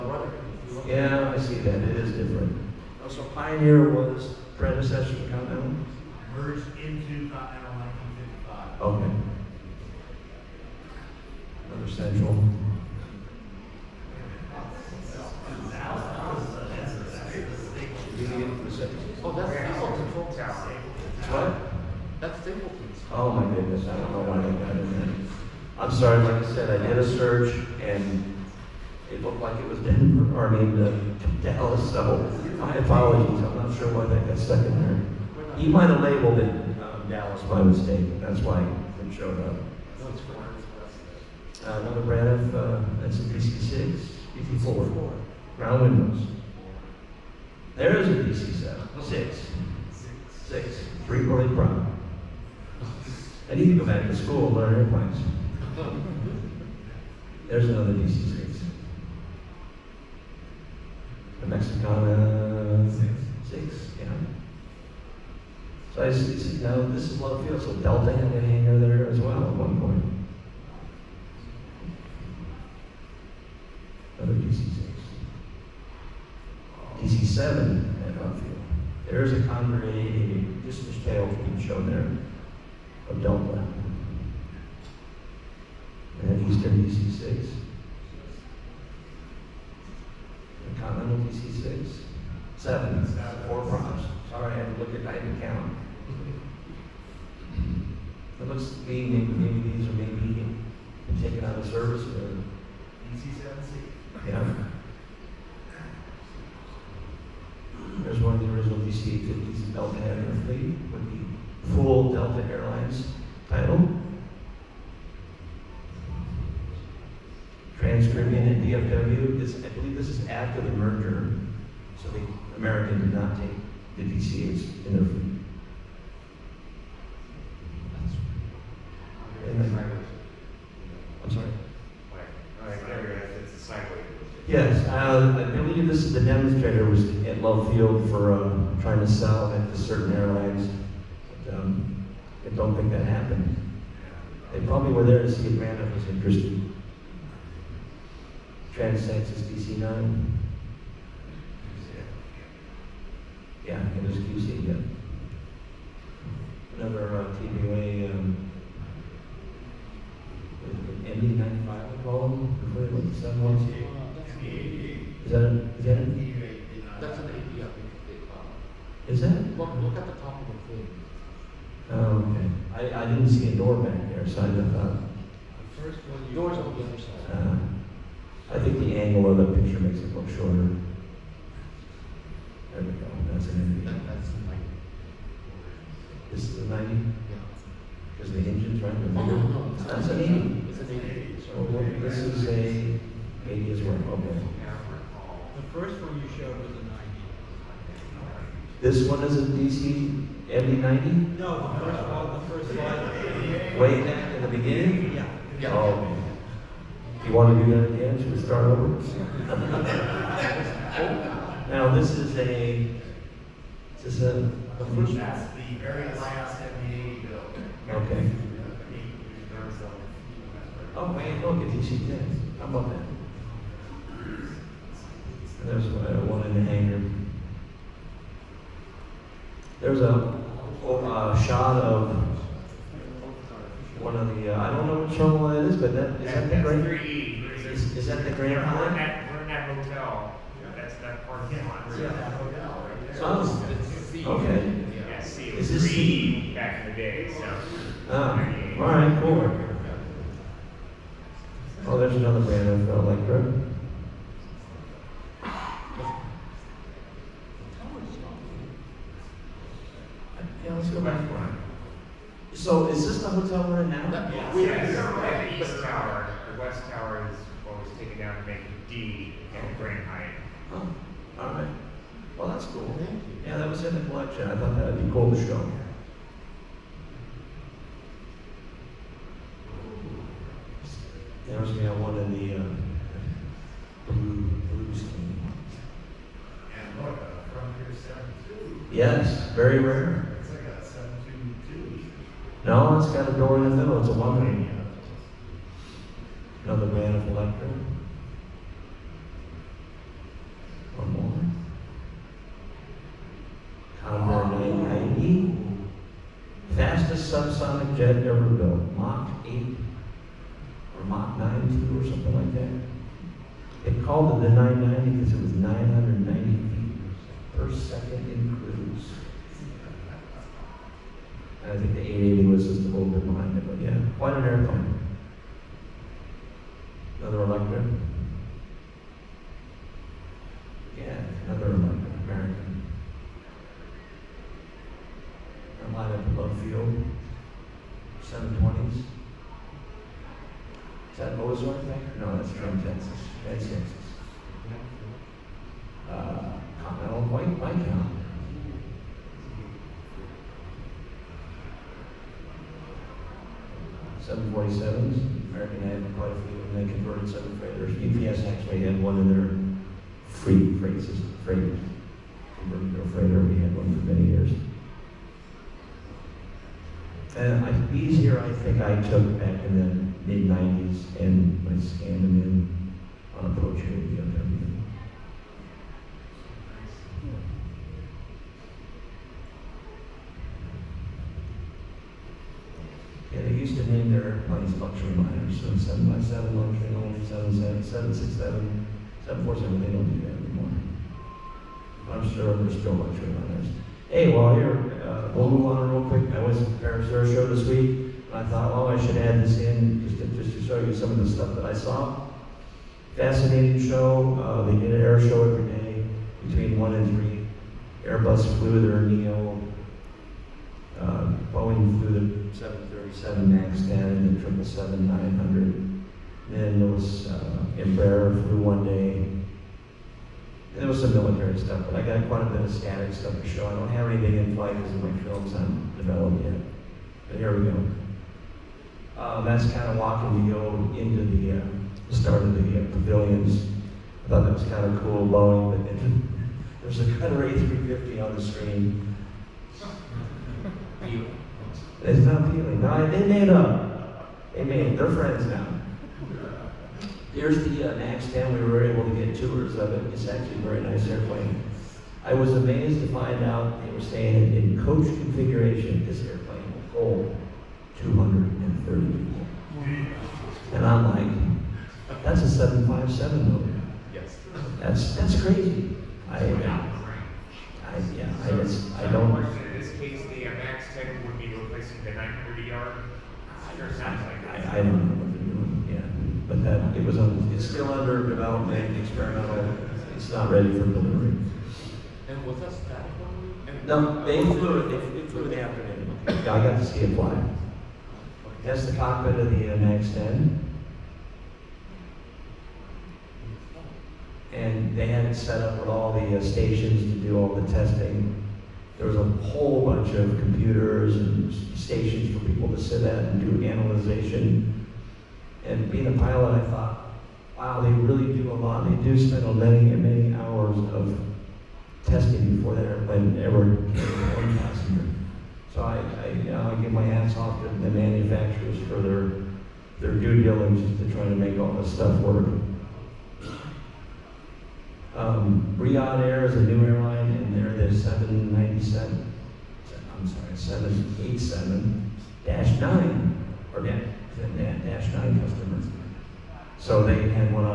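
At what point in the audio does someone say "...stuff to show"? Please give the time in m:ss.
7:03.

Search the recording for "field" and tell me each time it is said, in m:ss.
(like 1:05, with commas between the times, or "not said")
1:07, 1:18, 2:17, 5:36.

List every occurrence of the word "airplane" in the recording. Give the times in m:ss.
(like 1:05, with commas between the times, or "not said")
0:54, 5:24, 7:31, 7:36, 8:32.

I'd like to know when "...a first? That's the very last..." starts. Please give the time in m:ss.
3:34.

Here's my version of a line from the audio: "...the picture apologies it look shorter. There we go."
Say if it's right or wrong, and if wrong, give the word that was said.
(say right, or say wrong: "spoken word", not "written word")
wrong: "makes", not "apologies".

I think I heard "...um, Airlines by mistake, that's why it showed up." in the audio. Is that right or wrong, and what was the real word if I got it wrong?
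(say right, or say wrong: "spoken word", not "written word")
wrong: "Dallas", not "Airlines".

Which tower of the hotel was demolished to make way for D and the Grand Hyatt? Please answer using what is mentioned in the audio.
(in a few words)
The west tower.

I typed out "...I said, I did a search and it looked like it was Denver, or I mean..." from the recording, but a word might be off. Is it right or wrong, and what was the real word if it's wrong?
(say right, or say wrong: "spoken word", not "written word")
right.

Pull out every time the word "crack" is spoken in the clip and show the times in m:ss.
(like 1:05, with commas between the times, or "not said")
not said.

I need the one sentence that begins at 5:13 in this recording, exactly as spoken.
They called it the 990 because it was 990 feet per second in cruise.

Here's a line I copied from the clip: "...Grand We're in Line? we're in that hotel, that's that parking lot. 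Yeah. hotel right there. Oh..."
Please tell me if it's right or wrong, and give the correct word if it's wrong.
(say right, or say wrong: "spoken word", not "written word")
right.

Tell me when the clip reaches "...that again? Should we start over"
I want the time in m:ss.
3:27.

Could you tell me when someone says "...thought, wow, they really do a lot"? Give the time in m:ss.
8:26.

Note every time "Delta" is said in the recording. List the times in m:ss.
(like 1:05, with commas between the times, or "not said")
1:07, 1:23, 1:52.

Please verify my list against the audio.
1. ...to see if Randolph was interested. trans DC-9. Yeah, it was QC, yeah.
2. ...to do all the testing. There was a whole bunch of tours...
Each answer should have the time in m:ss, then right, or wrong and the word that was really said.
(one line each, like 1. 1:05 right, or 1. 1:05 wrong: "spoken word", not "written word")
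1. 2:25 right
2. 8:17 wrong: "computers", not "tours".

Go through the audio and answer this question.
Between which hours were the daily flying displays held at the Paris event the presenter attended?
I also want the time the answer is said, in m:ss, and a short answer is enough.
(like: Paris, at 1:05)
1 and 3, at 6:46.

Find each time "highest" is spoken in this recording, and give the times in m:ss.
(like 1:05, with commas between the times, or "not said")
not said.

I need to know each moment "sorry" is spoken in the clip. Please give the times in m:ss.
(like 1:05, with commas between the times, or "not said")
0:25, 1:34, 8:50.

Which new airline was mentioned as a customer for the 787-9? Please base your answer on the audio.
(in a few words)
Riyadh Air.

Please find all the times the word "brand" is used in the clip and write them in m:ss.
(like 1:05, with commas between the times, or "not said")
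0:42, 4:12.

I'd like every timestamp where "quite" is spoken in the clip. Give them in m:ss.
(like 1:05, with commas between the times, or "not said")
5:24, 5:56, 7:02.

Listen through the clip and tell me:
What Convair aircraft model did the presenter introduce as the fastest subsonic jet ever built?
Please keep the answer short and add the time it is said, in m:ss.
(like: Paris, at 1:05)
890, at 5:04.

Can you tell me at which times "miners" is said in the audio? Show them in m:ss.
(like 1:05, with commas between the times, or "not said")
6:25, 6:33.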